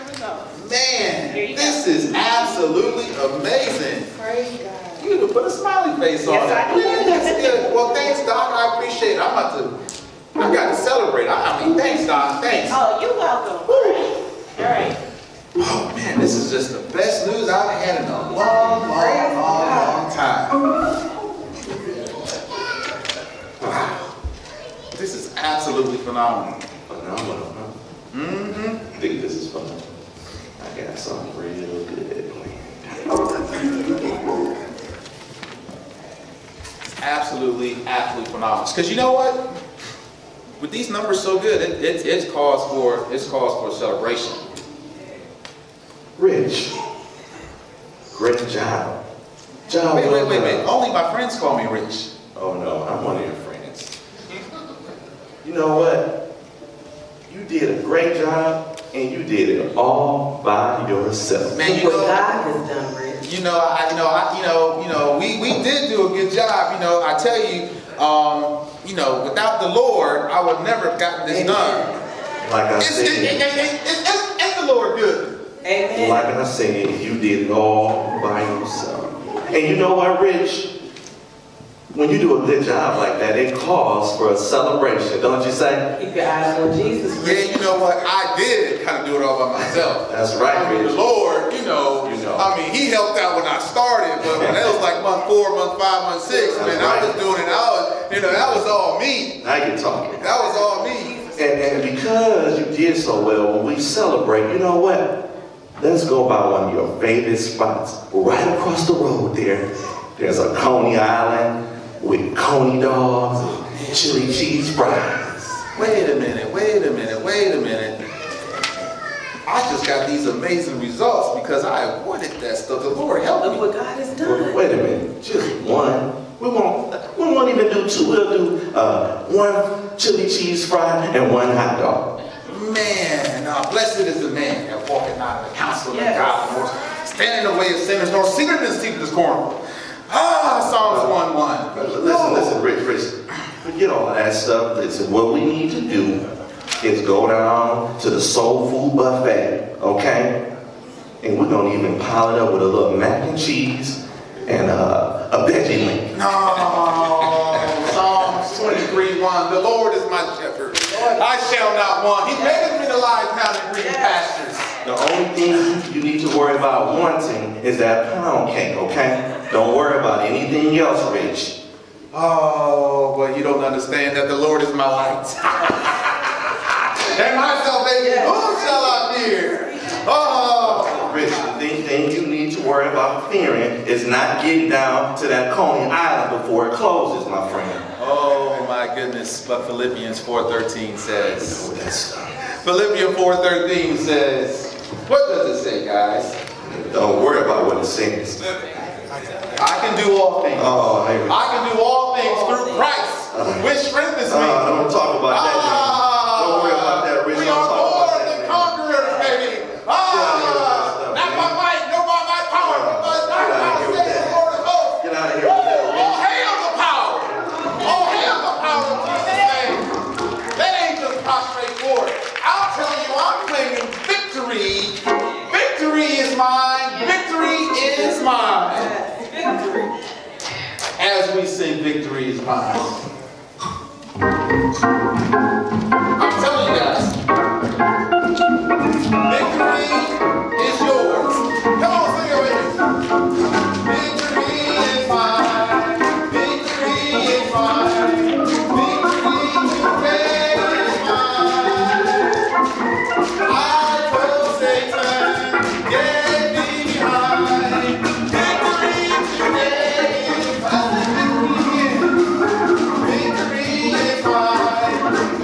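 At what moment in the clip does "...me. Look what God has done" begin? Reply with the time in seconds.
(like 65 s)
123 s.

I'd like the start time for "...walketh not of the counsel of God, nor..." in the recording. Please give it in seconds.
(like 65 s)
134 s.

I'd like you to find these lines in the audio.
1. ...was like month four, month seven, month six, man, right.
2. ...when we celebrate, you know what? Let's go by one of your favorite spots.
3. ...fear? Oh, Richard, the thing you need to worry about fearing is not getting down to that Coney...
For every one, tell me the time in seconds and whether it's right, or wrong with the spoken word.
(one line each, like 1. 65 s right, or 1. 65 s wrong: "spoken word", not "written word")
1. 94 s wrong: "five", not "seven"
2. 103 s right
3. 179 s right.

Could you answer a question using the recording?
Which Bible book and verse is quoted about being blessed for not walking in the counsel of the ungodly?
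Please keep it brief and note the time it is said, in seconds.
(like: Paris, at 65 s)
Psalms 1:1, at 140 s.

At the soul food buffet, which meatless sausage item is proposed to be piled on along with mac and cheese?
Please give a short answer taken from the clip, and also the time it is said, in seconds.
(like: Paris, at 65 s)
Veggie link, at 155 s.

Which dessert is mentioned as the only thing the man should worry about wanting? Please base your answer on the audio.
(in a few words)
Pound cake.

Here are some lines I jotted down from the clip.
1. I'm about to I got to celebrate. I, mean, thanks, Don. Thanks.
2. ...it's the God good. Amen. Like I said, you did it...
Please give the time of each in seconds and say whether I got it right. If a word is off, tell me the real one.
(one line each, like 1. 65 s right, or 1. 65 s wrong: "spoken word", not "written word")
1. 9 s right
2. 74 s wrong: "Lord", not "God".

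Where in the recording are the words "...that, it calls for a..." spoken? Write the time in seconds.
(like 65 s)
83 s.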